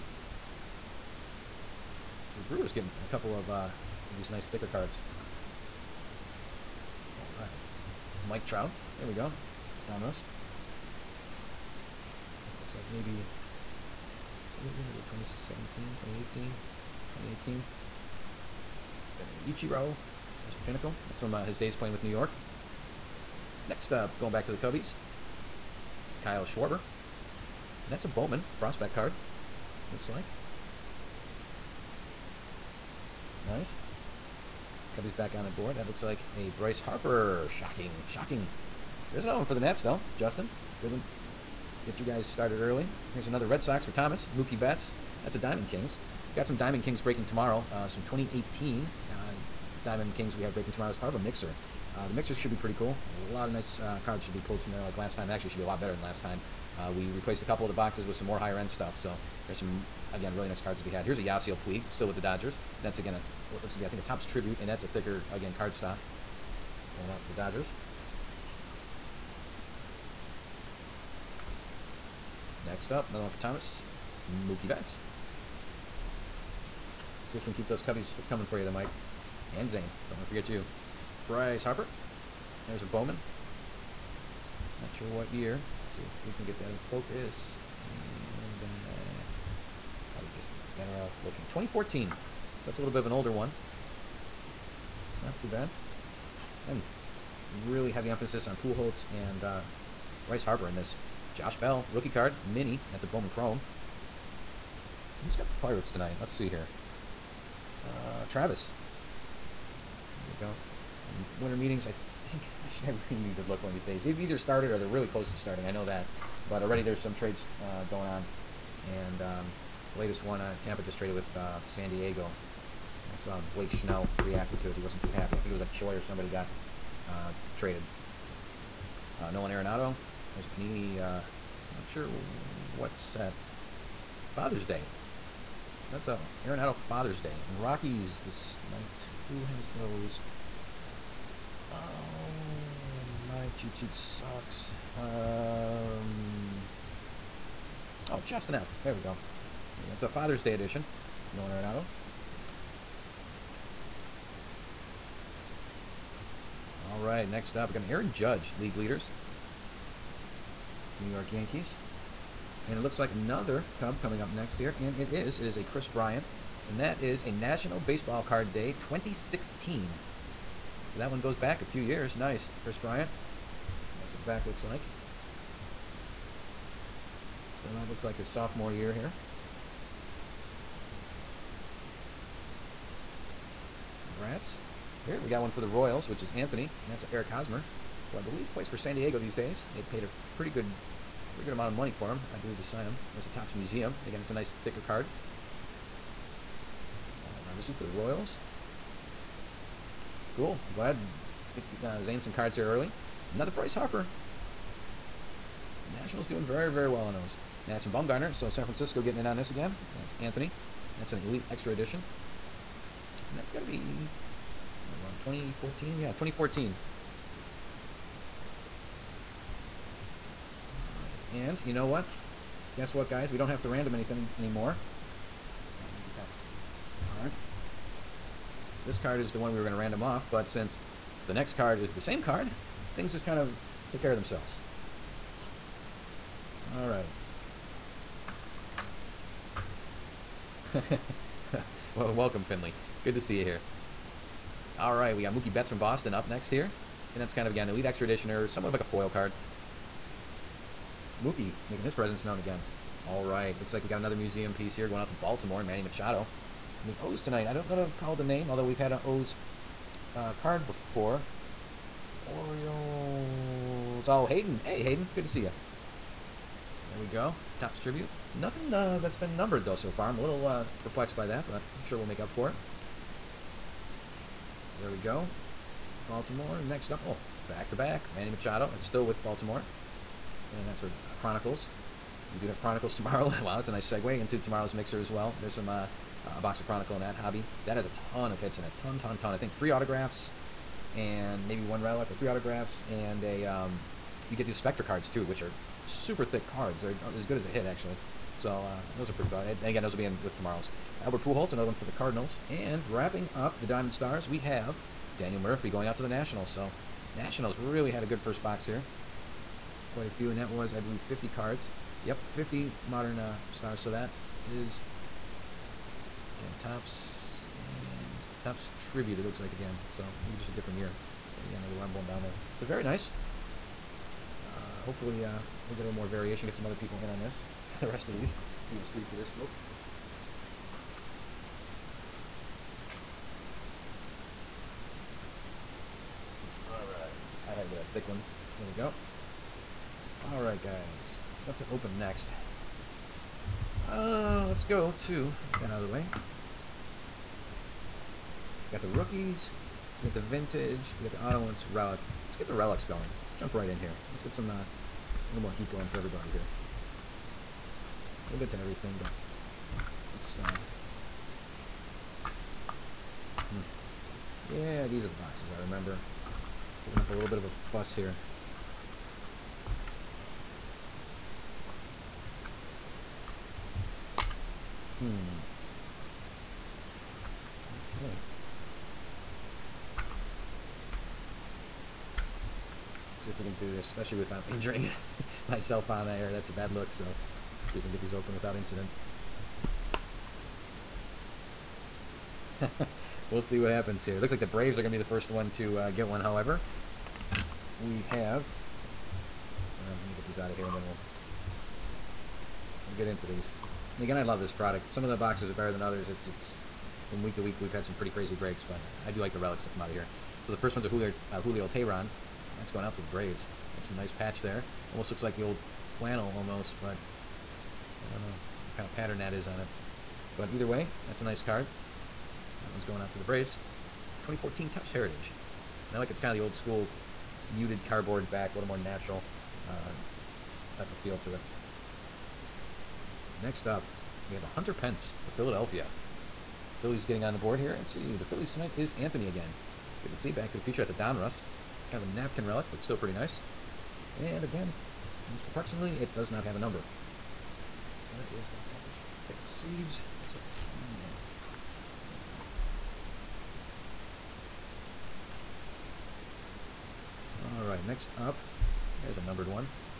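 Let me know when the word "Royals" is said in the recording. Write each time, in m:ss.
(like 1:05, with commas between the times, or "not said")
3:05, 3:17.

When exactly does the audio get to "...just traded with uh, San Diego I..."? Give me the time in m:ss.
2:00.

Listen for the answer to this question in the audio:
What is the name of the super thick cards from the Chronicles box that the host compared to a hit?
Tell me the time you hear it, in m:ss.
4:54.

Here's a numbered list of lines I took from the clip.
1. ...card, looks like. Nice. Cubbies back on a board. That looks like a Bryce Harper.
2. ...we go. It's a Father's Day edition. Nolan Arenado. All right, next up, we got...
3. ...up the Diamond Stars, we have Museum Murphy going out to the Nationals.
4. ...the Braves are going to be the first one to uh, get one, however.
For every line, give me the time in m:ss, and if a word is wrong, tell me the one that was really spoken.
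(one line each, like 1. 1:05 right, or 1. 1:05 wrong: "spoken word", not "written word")
1. 0:28 right
2. 2:29 right
3. 5:03 wrong: "Daniel", not "Museum"
4. 6:34 right.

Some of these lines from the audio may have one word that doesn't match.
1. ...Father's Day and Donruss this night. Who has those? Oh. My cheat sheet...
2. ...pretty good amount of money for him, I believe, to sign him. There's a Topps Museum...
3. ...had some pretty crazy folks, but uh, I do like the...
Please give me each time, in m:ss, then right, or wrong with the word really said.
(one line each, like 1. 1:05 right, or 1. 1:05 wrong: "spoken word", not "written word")
1. 2:16 wrong: "Rockies", not "Donruss"
2. 3:11 right
3. 6:47 wrong: "breaks", not "folks".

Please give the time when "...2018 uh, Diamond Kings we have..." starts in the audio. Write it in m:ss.
0:48.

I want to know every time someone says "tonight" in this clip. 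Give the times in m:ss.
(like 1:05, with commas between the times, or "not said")
1:45, 4:17, 7:18.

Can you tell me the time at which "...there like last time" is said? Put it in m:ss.
0:54.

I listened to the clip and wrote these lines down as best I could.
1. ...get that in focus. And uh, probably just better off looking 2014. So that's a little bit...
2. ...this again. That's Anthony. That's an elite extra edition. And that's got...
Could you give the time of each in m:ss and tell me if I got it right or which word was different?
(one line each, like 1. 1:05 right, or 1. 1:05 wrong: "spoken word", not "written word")
1. 1:26 right
2. 3:29 right.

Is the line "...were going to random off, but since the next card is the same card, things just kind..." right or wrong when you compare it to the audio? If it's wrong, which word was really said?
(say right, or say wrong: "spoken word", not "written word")
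right.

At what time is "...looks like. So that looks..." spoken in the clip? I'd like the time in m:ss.
2:54.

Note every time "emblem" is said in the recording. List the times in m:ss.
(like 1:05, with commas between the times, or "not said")
5:21.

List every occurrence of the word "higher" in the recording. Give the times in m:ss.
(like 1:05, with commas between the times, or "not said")
0:58.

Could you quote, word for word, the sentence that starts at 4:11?
Mookie making his presence known again.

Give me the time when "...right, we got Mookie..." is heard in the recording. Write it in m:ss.
4:04.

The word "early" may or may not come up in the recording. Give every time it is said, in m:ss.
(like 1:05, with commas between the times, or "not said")
0:42, 3:22.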